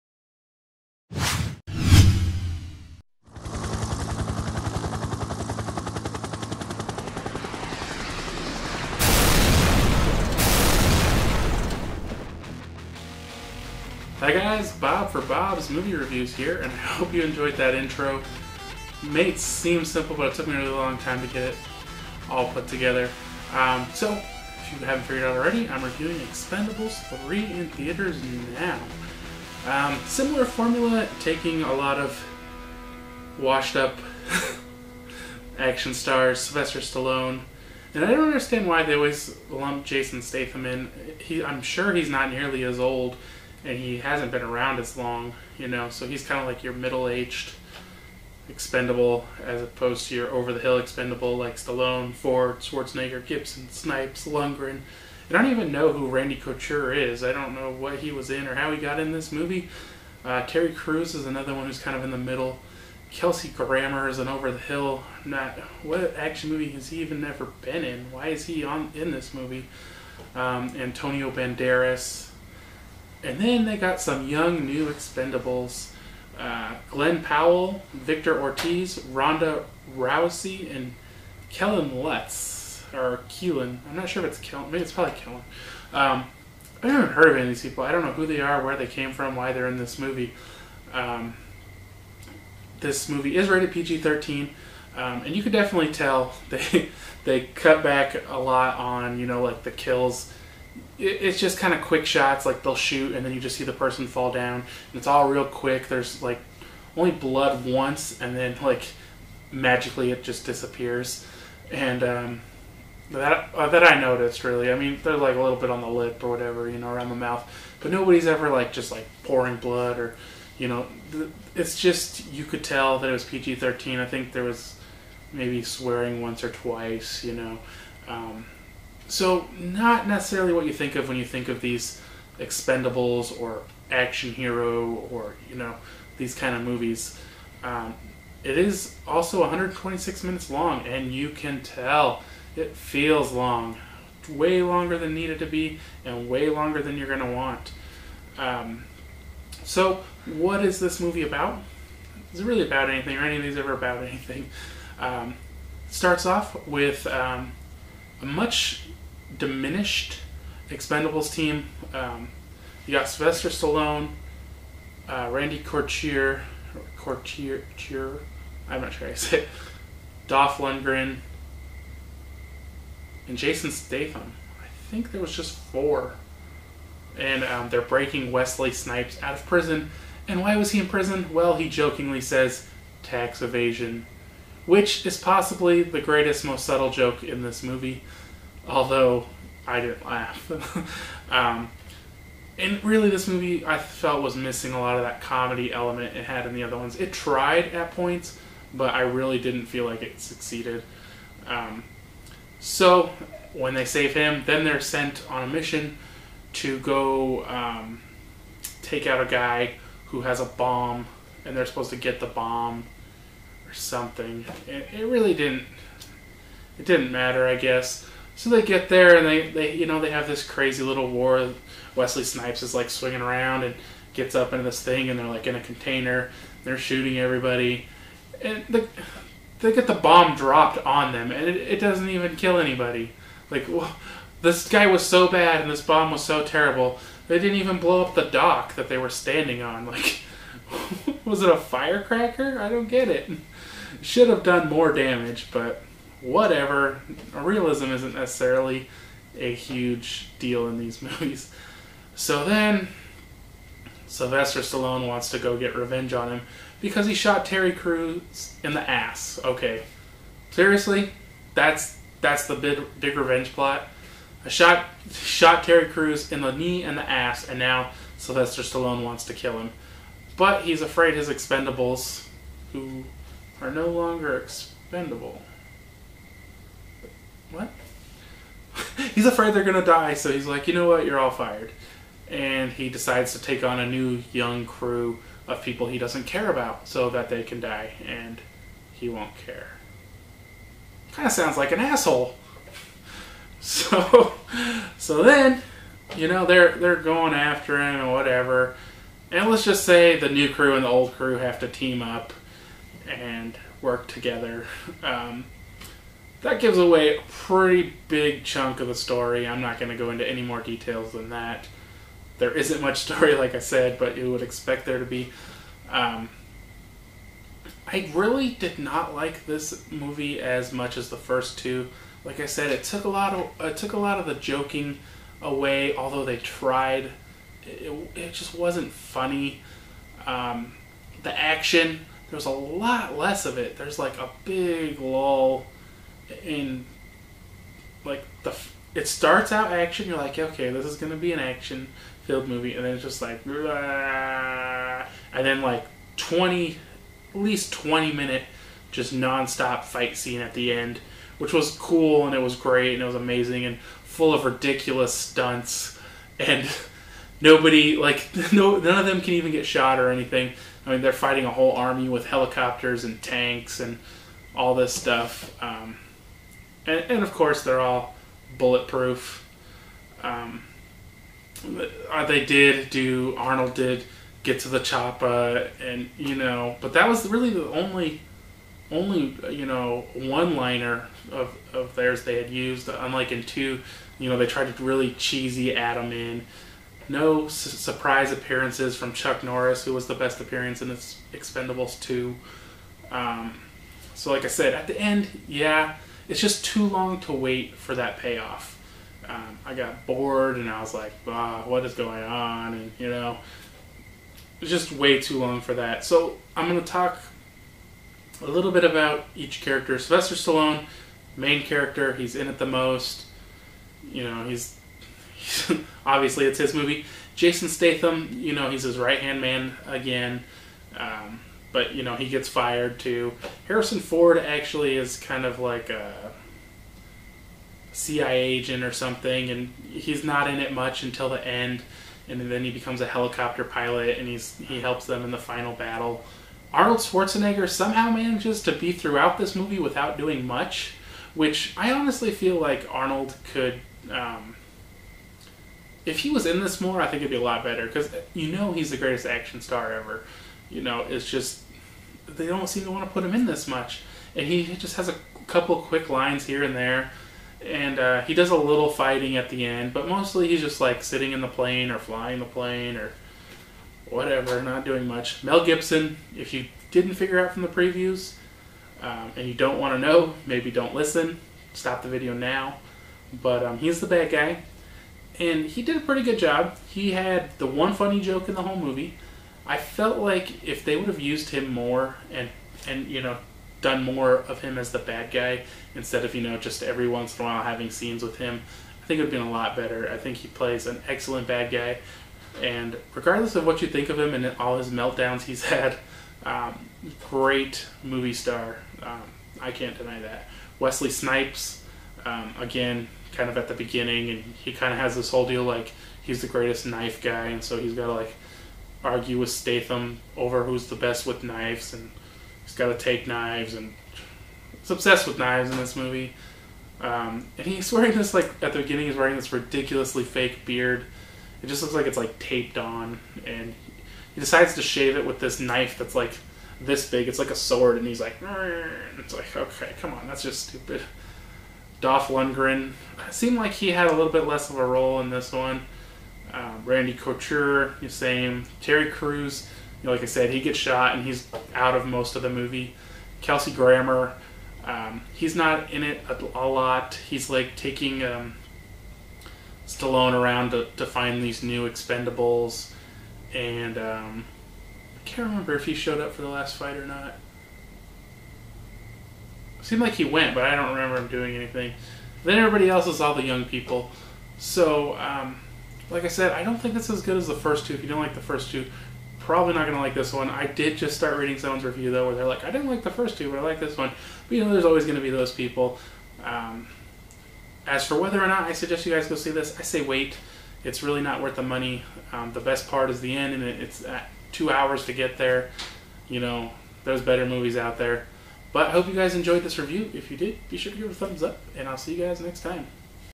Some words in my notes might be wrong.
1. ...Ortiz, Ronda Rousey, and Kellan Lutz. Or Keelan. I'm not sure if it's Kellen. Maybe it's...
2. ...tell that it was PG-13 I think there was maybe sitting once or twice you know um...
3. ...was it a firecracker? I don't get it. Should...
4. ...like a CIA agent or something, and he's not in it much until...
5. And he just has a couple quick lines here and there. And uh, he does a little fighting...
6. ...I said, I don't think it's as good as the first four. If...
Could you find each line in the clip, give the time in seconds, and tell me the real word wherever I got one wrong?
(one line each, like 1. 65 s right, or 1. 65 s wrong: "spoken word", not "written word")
1. 78 s right
2. 122 s wrong: "swearing", not "sitting"
3. 241 s right
4. 425 s right
5. 454 s right
6. 566 s wrong: "two", not "four".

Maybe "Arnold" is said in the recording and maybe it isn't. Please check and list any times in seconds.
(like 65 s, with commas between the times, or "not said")
373 s, 436 s, 442 s.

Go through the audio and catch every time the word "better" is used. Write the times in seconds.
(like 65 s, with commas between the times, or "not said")
447 s, 489 s, 587 s.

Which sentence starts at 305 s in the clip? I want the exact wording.
Um, that gives away a pretty big chunk of the story.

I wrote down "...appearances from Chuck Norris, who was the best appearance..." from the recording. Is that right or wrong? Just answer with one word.
right.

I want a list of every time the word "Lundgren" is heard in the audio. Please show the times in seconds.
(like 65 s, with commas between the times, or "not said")
54 s, 170 s, 532 s.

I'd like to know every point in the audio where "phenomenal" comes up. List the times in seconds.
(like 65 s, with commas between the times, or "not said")
not said.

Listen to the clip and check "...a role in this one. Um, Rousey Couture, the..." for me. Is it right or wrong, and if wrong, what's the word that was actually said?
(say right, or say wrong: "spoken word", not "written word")
wrong: "Randy", not "Rousey".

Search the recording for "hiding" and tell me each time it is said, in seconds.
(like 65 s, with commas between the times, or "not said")
not said.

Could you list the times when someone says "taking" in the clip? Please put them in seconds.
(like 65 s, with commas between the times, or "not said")
31 s, 547 s.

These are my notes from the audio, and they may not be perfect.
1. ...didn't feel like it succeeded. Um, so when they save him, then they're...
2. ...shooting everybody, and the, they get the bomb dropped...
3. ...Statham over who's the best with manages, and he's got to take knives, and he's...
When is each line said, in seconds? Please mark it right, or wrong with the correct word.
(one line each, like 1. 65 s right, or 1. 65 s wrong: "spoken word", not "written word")
1. 199 s right
2. 226 s right
3. 509 s wrong: "knives", not "manages".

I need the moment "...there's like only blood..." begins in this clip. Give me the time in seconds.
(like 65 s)
105 s.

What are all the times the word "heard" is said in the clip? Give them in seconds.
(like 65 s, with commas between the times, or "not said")
87 s.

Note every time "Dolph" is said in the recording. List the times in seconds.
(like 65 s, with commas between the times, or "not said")
170 s, 532 s.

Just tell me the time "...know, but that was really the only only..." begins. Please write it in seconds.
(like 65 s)
376 s.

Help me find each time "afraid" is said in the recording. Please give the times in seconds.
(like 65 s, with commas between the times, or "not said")
270 s, 279 s.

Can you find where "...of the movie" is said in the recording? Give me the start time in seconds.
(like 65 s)
542 s.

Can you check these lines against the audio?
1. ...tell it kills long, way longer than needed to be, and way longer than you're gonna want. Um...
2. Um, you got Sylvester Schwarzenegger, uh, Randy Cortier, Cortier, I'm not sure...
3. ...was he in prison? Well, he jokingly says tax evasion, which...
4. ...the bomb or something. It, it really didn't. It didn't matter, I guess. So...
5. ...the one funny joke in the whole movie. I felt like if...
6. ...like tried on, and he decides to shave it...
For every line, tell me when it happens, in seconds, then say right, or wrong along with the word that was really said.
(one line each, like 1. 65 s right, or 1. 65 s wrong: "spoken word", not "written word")
1. 141 s wrong: "feels", not "kills"
2. 161 s wrong: "Stallone", not "Schwarzenegger"
3. 180 s right
4. 212 s right
5. 477 s right
6. 522 s wrong: "taped", not "tried".